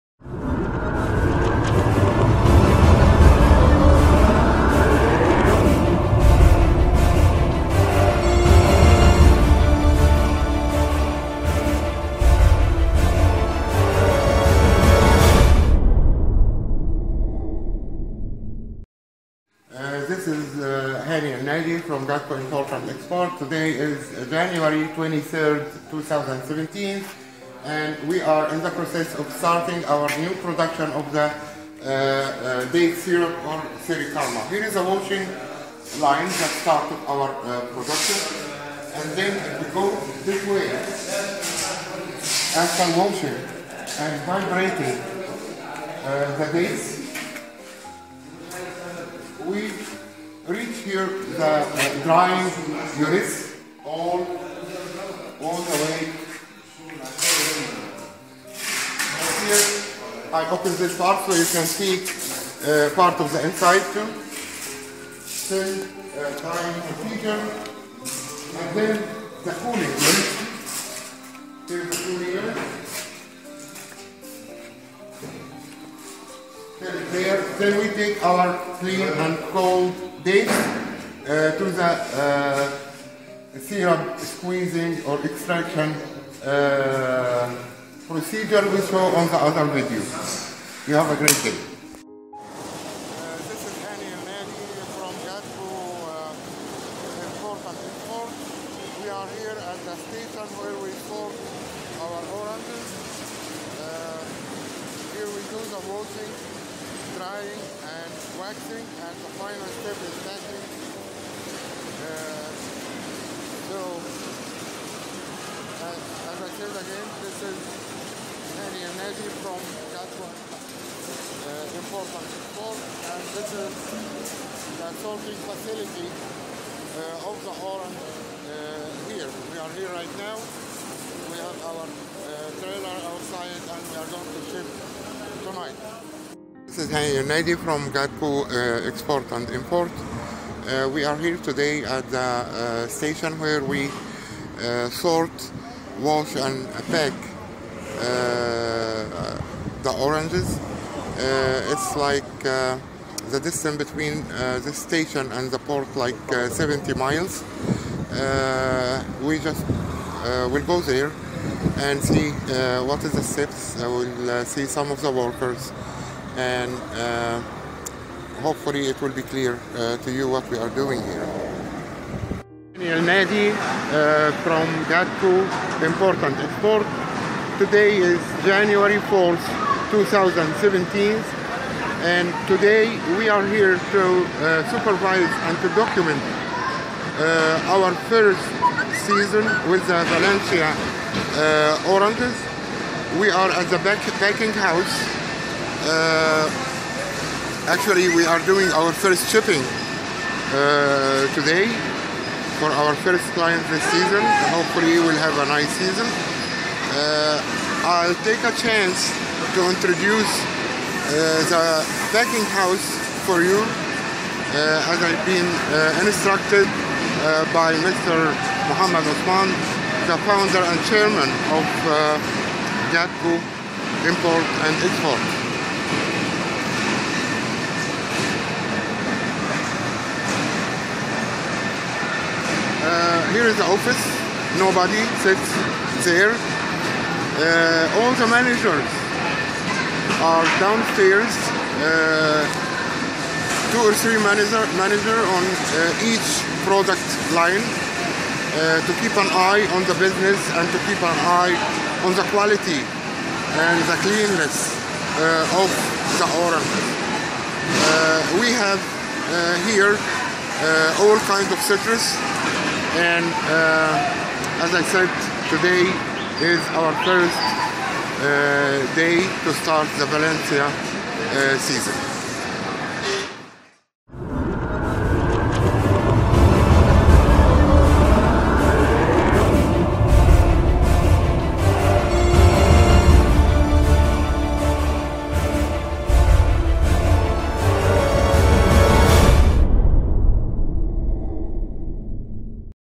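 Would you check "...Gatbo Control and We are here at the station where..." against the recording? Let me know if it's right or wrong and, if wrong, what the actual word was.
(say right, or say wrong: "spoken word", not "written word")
wrong: "Airport", not "Control".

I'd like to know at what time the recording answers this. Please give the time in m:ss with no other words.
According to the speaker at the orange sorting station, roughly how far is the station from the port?
2:36.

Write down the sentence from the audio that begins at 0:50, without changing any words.
here the uh, drying units all, all the way.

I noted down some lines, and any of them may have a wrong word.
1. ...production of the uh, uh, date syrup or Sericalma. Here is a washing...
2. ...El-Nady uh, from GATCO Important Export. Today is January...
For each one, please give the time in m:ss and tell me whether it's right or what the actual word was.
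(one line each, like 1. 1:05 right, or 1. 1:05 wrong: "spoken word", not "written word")
1. 0:30 right
2. 2:52 right.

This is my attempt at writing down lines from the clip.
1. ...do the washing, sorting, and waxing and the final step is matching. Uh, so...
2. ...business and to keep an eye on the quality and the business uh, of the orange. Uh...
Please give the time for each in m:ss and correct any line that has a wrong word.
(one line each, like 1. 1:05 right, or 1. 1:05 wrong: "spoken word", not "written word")
1. 1:45 wrong: "drying", not "sorting"
2. 4:09 wrong: "cleanness", not "business".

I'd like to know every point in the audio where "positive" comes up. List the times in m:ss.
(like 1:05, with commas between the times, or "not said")
not said.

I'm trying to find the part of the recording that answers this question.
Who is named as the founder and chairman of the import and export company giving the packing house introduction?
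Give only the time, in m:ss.
3:37.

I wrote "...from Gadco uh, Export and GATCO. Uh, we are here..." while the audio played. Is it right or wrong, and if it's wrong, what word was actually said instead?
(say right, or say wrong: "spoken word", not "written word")
wrong: "Import", not "GATCO".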